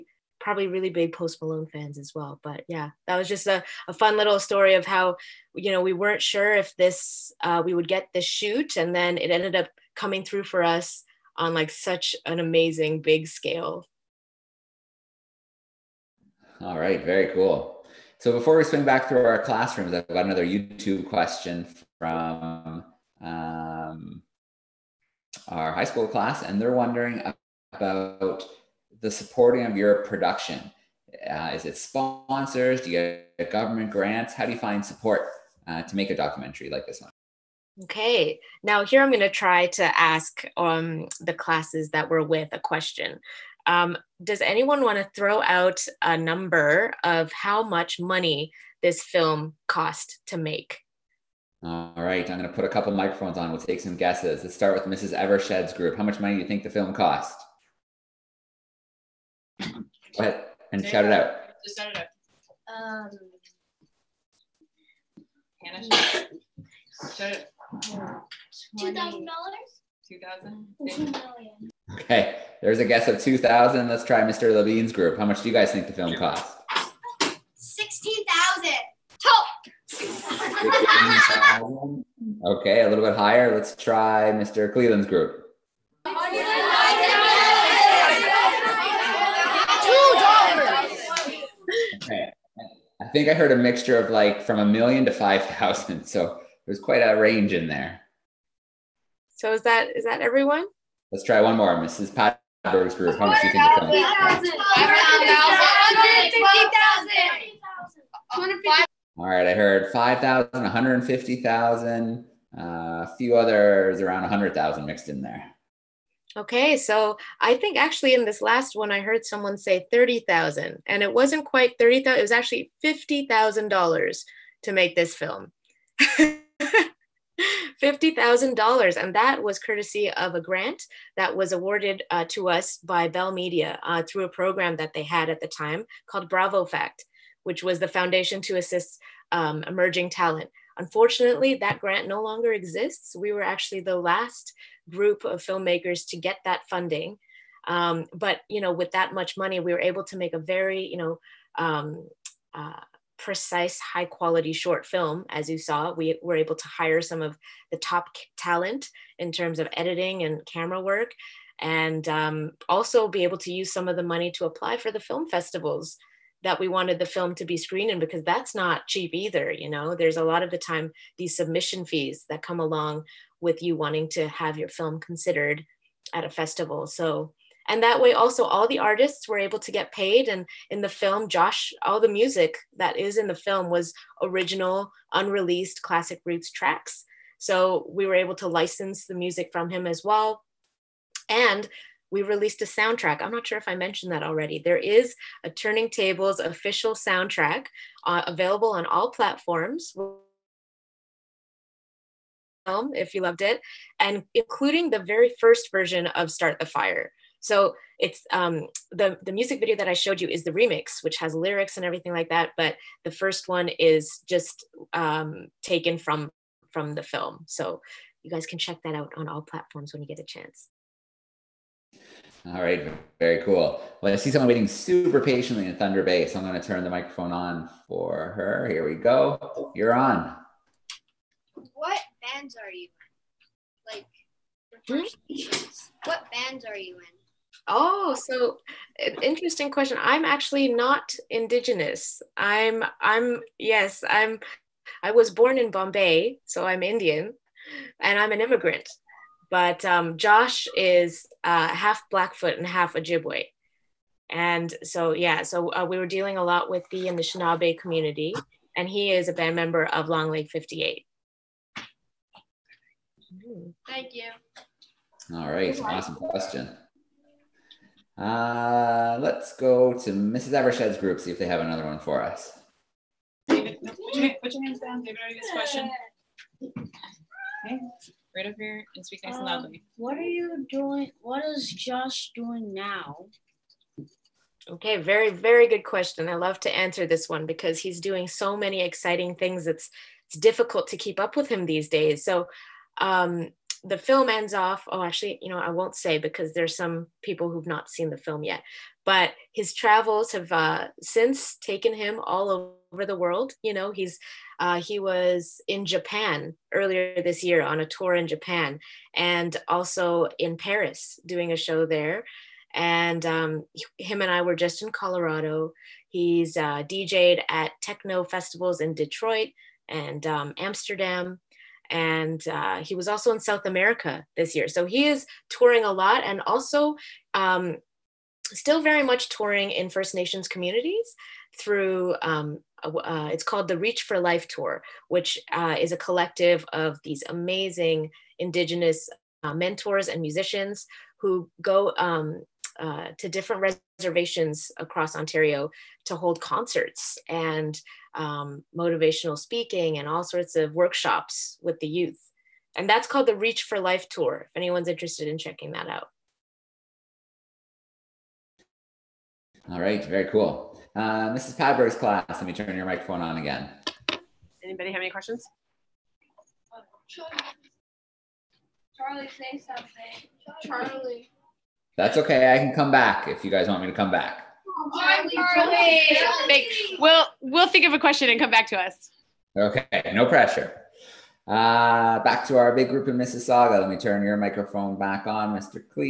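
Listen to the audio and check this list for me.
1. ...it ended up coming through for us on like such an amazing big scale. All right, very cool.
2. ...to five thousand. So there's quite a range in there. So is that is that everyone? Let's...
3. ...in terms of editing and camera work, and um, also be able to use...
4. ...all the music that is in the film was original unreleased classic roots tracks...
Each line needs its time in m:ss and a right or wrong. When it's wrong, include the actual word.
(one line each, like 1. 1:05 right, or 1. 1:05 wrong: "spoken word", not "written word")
1. 0:09 right
2. 1:35 right
3. 2:39 right
4. 3:01 right.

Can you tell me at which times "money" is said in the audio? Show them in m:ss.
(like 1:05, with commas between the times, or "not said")
0:47, 0:56, 2:29, 2:44.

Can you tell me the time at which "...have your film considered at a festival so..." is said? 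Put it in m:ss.
2:54.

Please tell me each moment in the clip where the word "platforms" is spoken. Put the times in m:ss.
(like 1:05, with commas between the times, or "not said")
3:19, 3:39.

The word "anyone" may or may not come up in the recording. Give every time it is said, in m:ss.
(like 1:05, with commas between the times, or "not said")
0:44, 5:54.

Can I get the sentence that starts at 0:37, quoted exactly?
Okay, now here I'm going to try to ask um, the classes that we're with a question.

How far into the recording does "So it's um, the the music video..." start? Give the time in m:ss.
3:27.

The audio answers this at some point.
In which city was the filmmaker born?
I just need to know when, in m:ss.
4:05.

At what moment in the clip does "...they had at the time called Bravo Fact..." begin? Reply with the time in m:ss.
2:14.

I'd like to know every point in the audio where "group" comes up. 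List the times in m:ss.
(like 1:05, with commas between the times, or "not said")
0:55, 1:14, 1:25, 1:42, 2:24, 4:30, 6:22.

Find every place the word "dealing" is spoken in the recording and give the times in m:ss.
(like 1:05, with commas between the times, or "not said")
4:16.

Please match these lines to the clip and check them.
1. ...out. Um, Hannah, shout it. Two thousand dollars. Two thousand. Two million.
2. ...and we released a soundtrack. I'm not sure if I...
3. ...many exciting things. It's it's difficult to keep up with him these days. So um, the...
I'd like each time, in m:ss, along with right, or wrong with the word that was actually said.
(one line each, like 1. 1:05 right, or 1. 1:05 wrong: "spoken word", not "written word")
1. 1:01 right
2. 3:11 right
3. 4:48 right.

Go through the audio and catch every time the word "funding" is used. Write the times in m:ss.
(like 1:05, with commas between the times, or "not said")
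2:26.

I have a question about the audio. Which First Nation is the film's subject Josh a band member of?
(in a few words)
Long Lake 58.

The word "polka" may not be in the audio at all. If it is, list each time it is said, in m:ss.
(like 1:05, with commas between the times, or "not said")
not said.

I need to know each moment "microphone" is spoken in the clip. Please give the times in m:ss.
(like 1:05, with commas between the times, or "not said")
0:52, 3:46, 6:02, 6:24.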